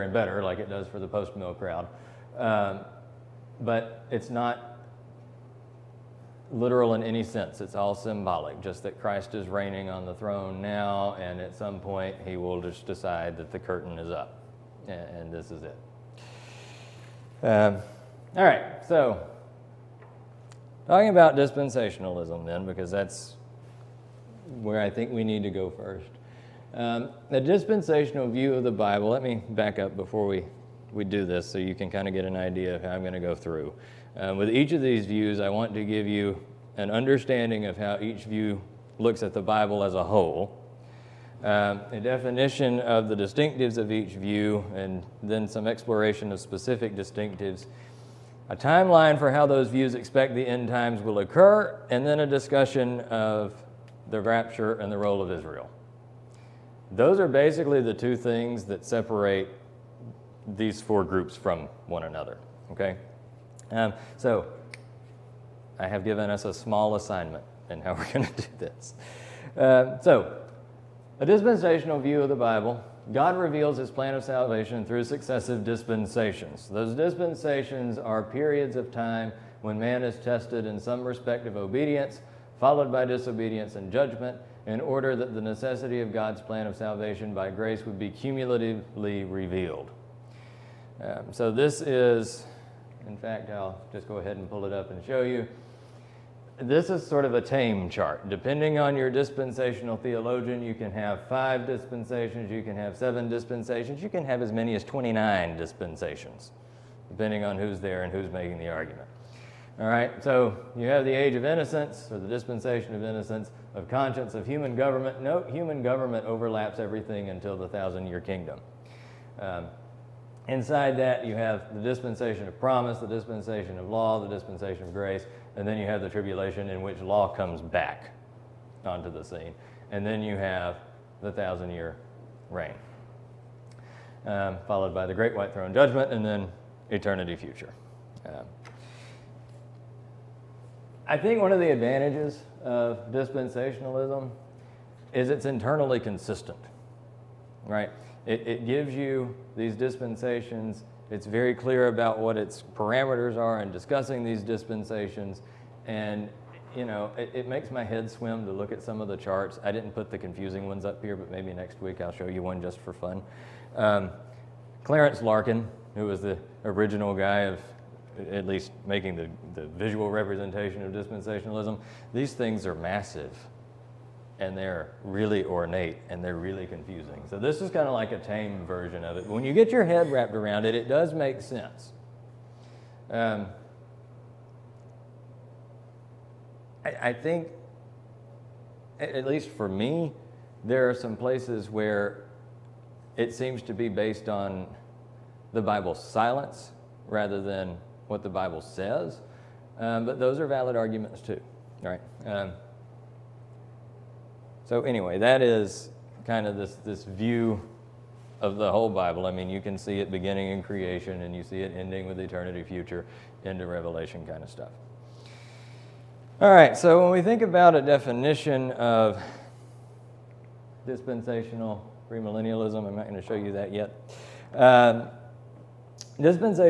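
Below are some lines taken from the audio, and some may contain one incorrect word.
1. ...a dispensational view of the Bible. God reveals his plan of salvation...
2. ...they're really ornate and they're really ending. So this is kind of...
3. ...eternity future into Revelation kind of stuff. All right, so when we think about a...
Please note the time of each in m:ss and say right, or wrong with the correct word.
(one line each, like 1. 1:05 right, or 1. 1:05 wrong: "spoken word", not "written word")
1. 1:11 right
2. 2:54 wrong: "confusing", not "ending"
3. 3:32 right.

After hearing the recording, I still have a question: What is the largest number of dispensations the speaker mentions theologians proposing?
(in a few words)
29.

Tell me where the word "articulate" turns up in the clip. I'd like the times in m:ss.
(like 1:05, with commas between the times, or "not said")
not said.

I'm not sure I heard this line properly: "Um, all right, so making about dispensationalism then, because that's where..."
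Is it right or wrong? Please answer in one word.
wrong.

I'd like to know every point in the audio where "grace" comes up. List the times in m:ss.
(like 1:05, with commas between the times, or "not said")
1:27, 2:04.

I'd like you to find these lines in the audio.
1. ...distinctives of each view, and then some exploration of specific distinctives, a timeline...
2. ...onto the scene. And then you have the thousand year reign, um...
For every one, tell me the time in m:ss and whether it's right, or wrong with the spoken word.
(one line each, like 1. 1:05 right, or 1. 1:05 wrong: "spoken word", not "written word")
1. 0:43 right
2. 2:08 right.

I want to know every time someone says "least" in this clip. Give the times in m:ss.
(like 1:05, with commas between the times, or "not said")
2:48, 3:09.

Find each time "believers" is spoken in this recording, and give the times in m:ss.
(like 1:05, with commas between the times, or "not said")
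not said.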